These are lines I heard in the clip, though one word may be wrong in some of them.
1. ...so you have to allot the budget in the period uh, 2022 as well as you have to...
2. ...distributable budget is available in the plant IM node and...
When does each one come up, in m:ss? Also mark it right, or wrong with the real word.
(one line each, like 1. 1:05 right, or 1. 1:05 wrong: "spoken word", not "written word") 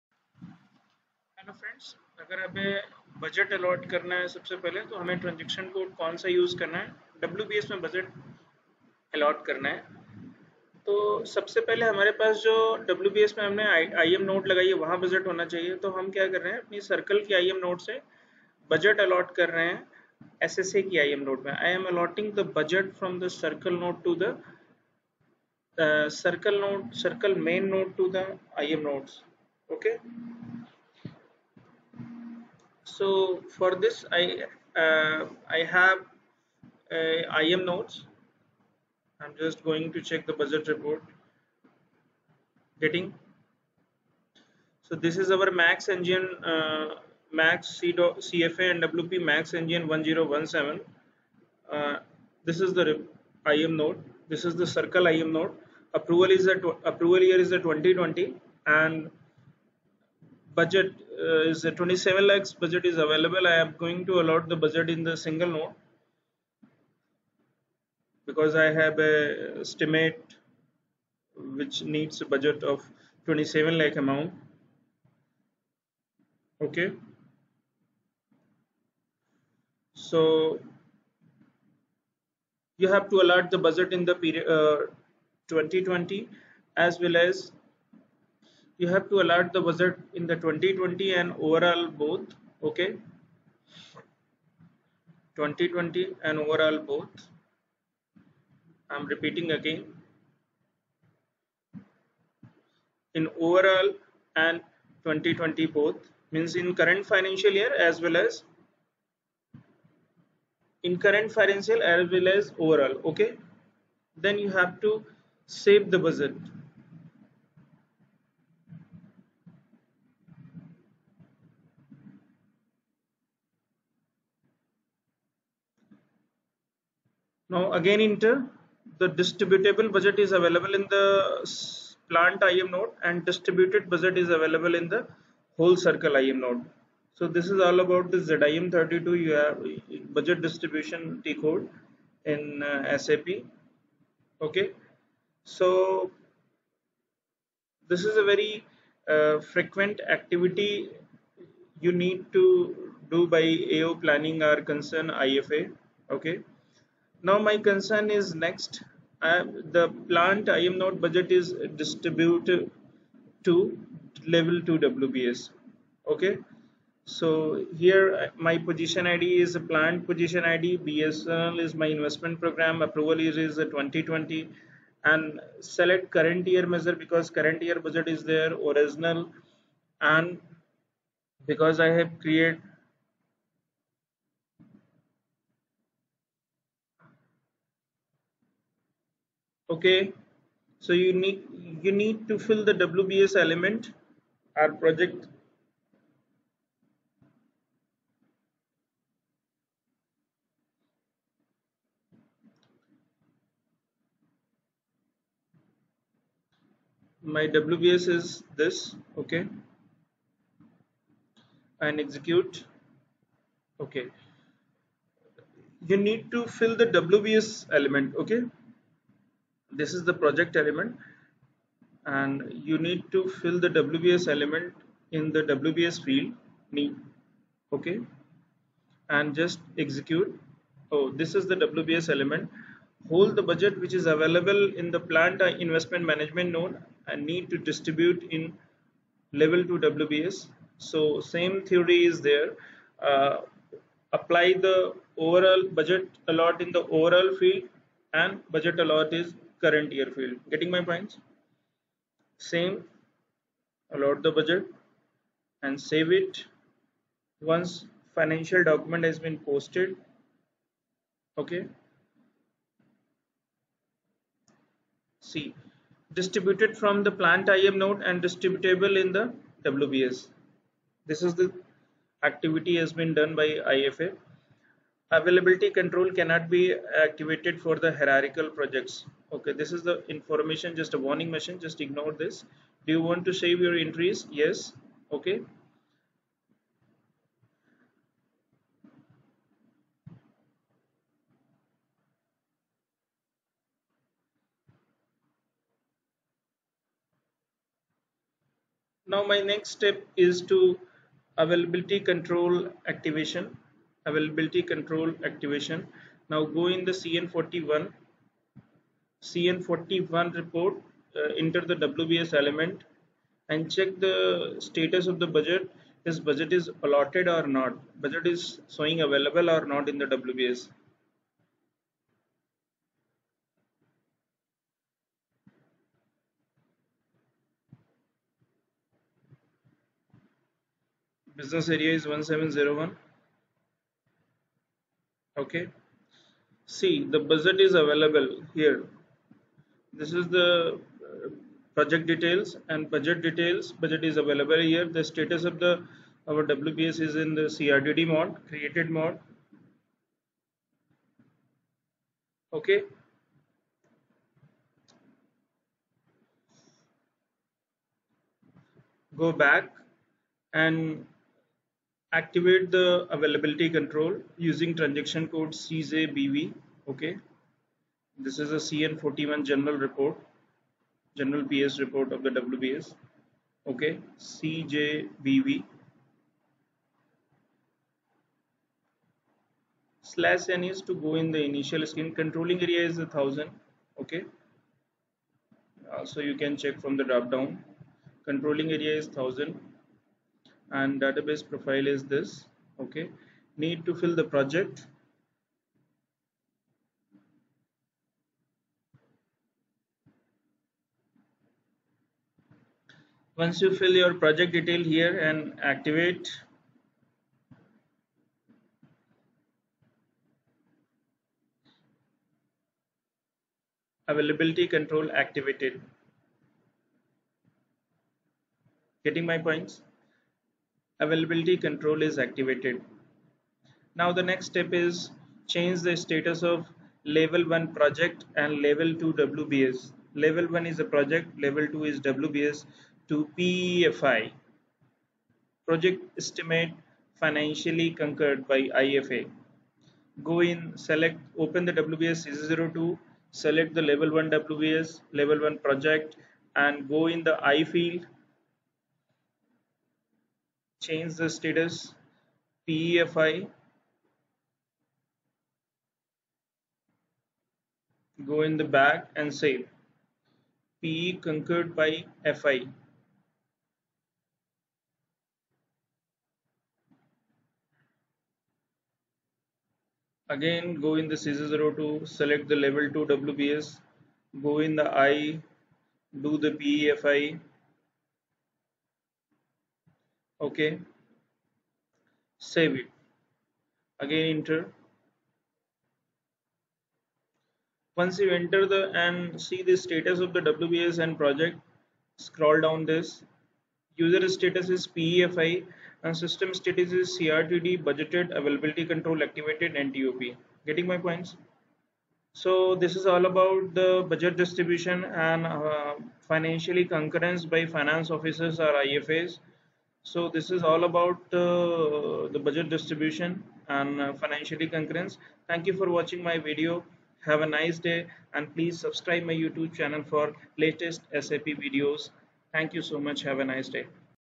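1. 1:20 wrong: "2020", not "2022"
2. 2:09 right.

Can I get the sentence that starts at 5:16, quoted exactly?
This budget is allotted or not.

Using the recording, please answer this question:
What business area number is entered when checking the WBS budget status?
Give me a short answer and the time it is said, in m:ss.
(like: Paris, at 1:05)
1701, at 5:32.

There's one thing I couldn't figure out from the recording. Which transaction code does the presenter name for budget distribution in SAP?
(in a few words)
ZIM32.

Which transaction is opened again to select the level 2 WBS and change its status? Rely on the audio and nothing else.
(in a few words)
CJ02.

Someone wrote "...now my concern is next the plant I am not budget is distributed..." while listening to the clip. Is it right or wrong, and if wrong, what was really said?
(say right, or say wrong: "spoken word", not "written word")
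right.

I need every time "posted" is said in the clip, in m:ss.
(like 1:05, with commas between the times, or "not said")
4:19.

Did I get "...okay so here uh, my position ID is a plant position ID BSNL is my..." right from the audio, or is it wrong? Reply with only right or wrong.
right.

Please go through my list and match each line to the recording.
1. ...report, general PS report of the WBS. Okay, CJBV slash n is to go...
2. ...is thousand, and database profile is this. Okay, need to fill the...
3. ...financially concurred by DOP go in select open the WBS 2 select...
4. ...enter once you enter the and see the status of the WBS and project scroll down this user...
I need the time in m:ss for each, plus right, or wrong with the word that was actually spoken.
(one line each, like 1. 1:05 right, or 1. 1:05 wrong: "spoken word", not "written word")
1. 6:09 right
2. 6:28 right
3. 7:17 wrong: "IFA", not "DOP"
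4. 8:04 right.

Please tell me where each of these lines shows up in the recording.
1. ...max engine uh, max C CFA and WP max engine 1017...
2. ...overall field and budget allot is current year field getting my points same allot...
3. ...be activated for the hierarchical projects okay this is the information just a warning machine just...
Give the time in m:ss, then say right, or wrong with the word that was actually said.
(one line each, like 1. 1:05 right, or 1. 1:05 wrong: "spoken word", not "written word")
1. 0:45 right
2. 4:06 right
3. 4:36 right.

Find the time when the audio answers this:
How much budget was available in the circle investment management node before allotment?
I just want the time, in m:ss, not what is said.
1:01.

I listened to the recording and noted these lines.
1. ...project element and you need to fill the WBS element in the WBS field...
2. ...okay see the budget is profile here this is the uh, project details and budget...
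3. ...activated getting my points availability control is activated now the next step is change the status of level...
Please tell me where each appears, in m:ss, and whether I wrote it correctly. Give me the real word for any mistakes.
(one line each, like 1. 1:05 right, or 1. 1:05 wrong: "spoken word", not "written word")
1. 3:40 right
2. 5:35 wrong: "available", not "profile"
3. 6:55 right.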